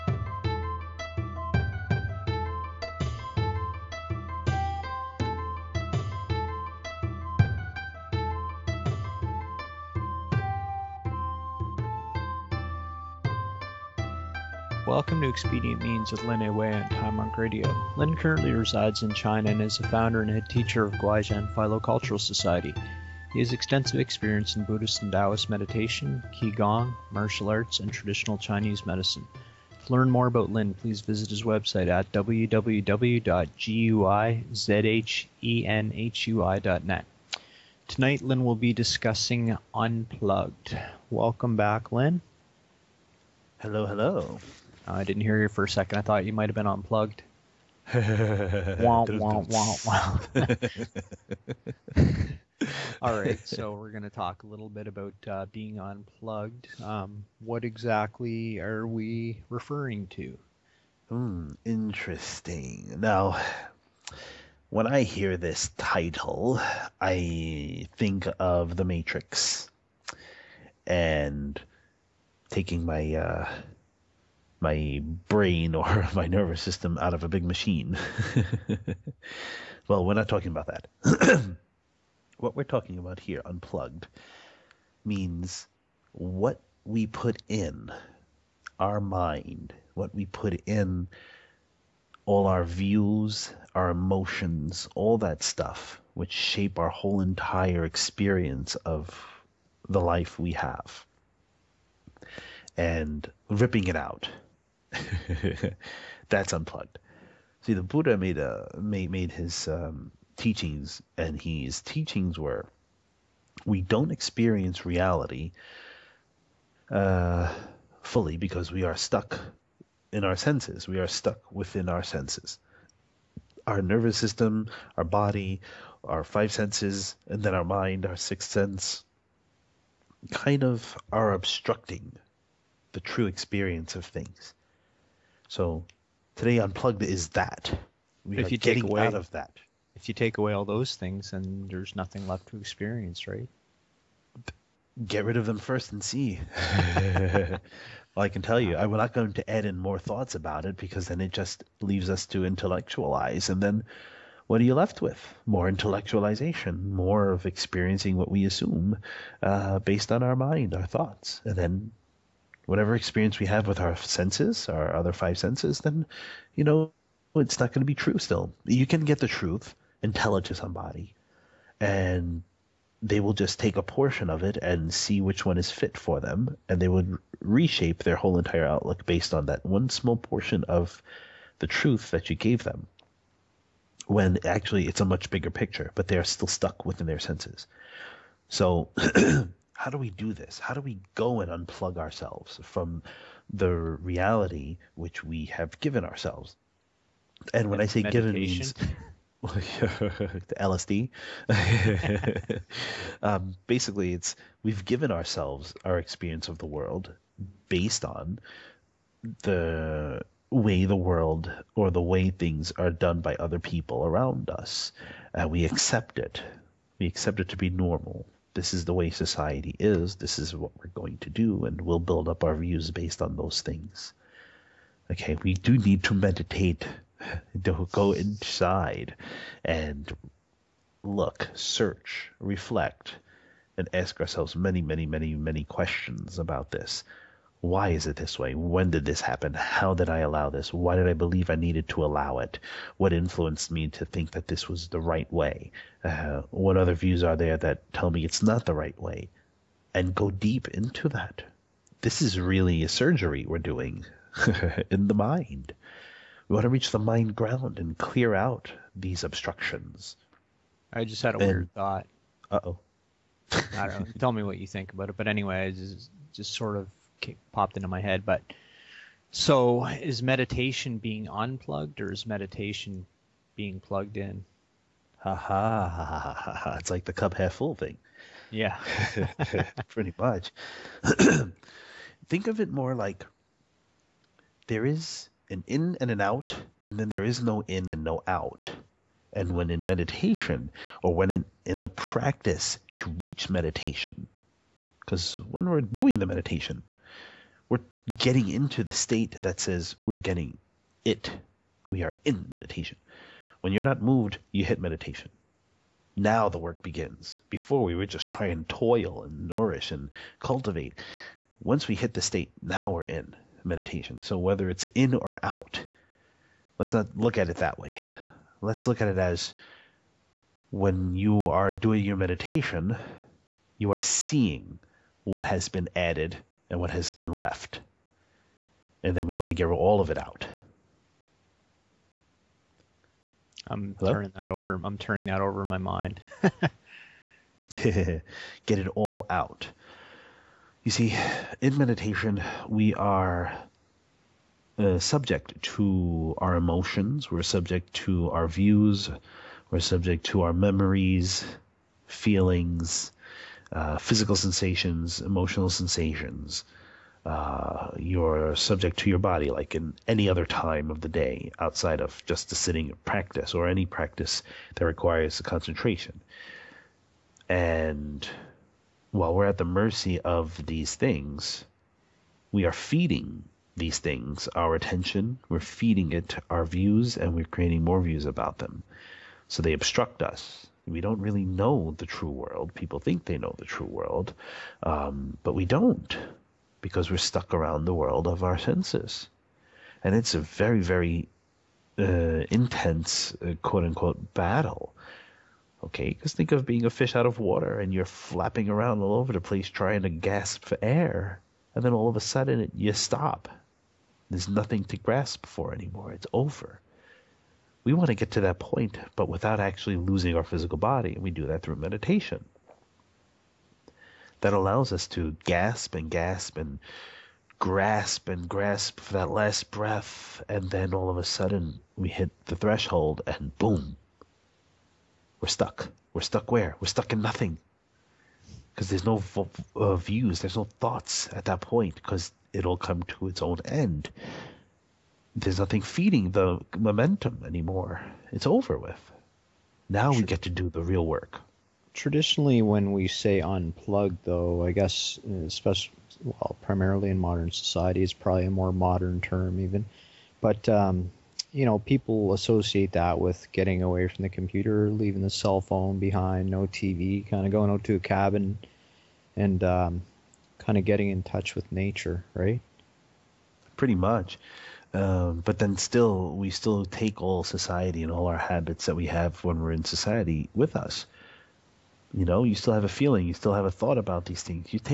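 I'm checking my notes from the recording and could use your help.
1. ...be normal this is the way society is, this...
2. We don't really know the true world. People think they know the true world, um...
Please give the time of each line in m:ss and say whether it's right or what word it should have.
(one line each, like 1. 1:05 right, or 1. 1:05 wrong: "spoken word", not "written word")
1. 3:37 right
2. 6:20 right.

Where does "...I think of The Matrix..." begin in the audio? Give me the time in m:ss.
1:07.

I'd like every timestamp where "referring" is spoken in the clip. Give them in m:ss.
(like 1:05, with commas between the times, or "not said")
0:59.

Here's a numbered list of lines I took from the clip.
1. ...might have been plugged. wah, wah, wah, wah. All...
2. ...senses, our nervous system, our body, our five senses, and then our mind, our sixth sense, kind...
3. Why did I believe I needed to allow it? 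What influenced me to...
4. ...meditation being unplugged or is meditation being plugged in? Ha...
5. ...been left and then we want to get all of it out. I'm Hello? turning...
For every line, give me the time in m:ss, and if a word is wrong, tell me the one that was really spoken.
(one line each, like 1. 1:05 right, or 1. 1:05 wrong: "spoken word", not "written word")
1. 0:46 wrong: "unplugged", not "plugged"
2. 2:02 right
3. 4:00 right
4. 4:30 right
5. 5:27 right.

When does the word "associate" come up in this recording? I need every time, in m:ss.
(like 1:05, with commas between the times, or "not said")
7:32.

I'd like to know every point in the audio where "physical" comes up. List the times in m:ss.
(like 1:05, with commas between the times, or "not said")
5:53, 6:50.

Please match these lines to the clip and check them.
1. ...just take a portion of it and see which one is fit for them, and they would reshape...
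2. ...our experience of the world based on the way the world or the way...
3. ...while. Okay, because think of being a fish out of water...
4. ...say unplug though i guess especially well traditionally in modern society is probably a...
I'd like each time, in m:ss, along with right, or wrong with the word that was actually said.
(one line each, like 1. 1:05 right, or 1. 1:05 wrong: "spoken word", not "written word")
1. 2:53 right
2. 3:25 right
3. 6:34 wrong: "battle", not "while"
4. 7:23 wrong: "primarily", not "traditionally".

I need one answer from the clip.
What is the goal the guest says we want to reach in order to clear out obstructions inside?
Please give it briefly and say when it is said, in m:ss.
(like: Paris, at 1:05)
the mind ground, at 4:16.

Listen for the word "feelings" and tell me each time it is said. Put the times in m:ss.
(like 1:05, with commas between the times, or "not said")
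5:52, 7:52.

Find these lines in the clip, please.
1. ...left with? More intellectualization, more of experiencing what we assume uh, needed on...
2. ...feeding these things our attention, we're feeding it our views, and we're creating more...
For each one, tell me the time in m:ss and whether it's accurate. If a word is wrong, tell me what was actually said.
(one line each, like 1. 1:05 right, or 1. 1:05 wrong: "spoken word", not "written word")
1. 2:34 wrong: "based", not "needed"
2. 6:12 right.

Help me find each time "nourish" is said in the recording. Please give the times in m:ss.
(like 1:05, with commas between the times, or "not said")
5:09.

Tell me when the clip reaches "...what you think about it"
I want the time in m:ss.
4:24.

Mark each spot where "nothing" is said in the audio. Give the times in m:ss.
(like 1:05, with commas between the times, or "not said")
2:21, 6:44, 7:07, 7:15.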